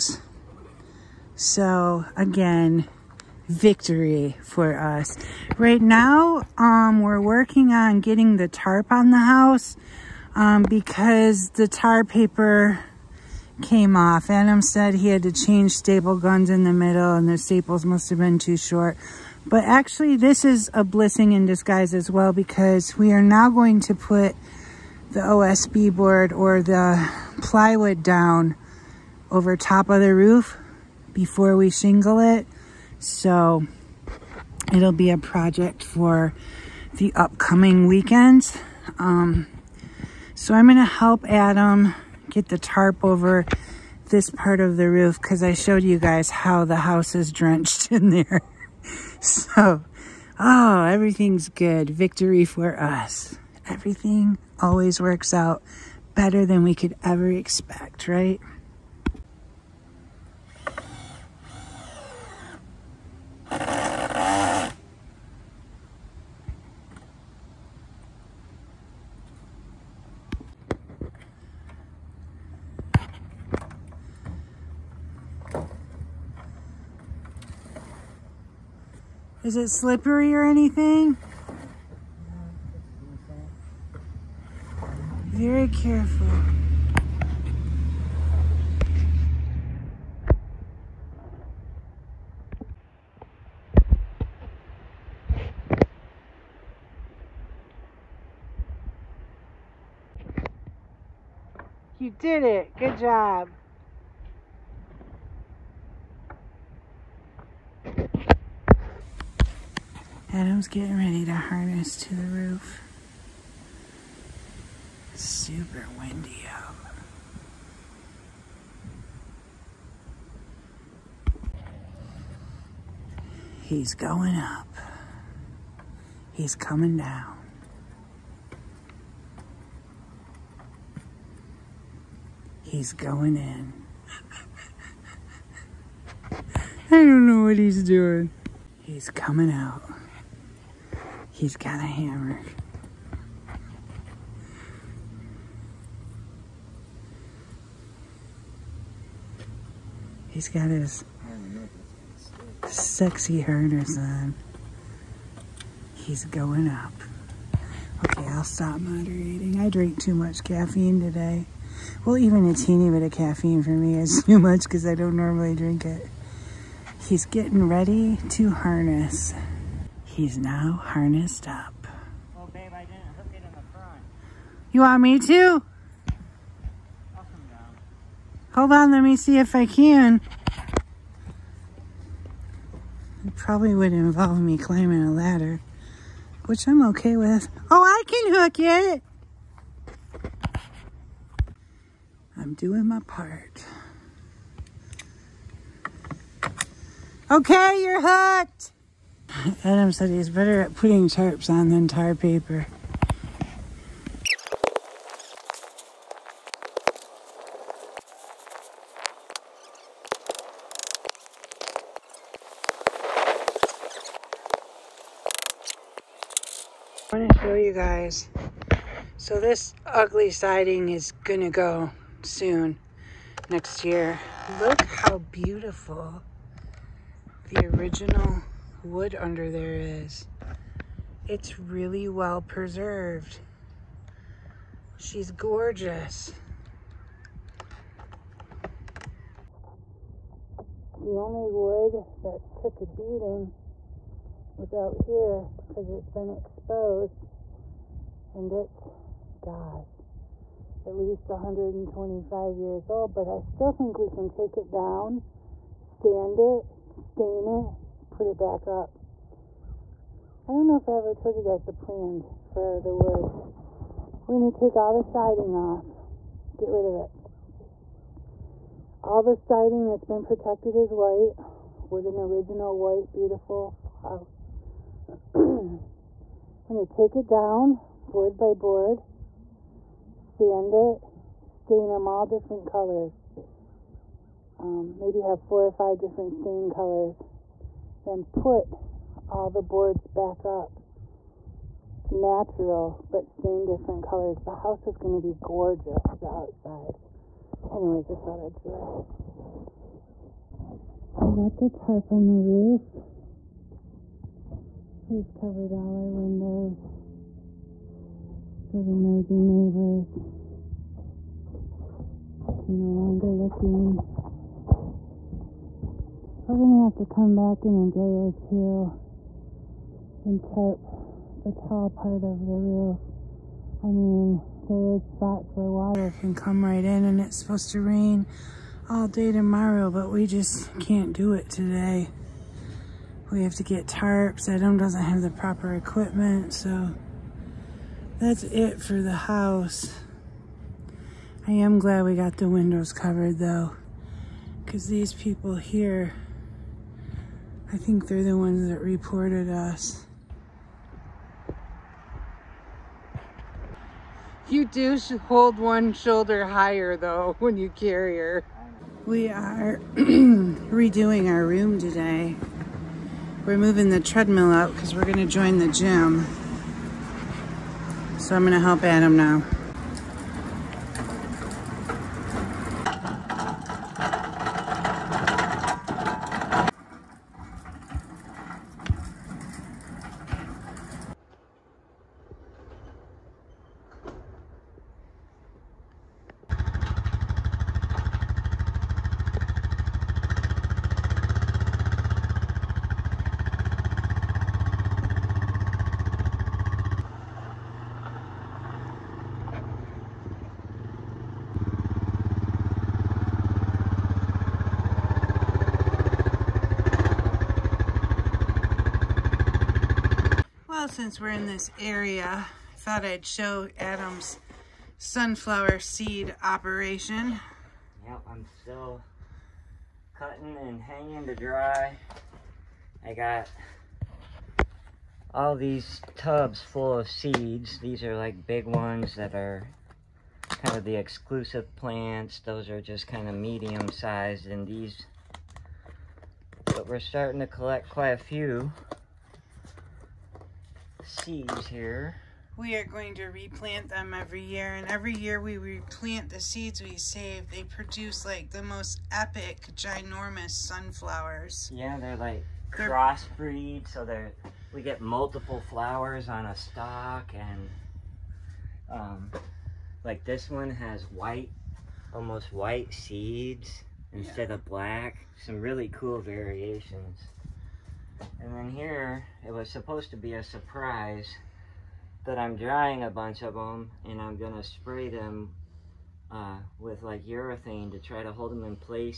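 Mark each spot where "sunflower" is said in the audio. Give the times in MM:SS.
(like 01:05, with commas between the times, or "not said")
06:54, 07:30.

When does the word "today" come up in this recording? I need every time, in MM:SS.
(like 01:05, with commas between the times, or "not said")
02:40, 05:31, 06:01.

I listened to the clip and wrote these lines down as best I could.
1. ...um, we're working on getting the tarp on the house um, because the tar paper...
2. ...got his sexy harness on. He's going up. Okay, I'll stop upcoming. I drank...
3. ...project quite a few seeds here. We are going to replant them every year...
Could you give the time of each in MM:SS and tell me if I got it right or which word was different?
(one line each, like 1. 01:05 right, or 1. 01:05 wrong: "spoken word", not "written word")
1. 00:06 right
2. 02:30 wrong: "moderating", not "upcoming"
3. 07:17 wrong: "collect", not "project".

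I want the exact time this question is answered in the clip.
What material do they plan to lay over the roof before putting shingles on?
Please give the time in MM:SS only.
00:25.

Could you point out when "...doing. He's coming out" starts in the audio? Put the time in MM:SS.
02:17.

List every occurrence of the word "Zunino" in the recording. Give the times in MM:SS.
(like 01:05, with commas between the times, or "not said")
not said.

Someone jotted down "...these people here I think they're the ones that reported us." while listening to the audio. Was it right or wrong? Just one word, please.
right.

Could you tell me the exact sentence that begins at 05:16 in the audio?
We're gonna have to come back in a day or two and tarp the tall part of the roof.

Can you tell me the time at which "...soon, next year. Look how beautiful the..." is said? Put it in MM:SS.
03:42.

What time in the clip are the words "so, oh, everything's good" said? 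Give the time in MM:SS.
00:49.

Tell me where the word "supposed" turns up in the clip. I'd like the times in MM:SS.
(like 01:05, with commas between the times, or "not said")
05:27, 07:49.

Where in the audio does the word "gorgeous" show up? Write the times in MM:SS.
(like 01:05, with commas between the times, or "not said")
03:55, 04:55.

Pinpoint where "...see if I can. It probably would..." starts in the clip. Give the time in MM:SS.
02:59.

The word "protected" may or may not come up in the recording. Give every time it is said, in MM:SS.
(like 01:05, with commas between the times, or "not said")
04:30.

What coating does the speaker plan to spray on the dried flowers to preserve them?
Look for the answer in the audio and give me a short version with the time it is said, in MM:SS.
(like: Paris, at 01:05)
Urethane, at 07:57.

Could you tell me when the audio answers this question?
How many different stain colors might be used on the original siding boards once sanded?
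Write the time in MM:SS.
04:45.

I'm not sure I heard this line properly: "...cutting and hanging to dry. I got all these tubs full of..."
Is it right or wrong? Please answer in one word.
right.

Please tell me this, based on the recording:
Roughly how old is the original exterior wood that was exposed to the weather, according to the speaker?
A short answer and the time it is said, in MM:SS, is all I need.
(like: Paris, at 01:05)
125 years, at 04:11.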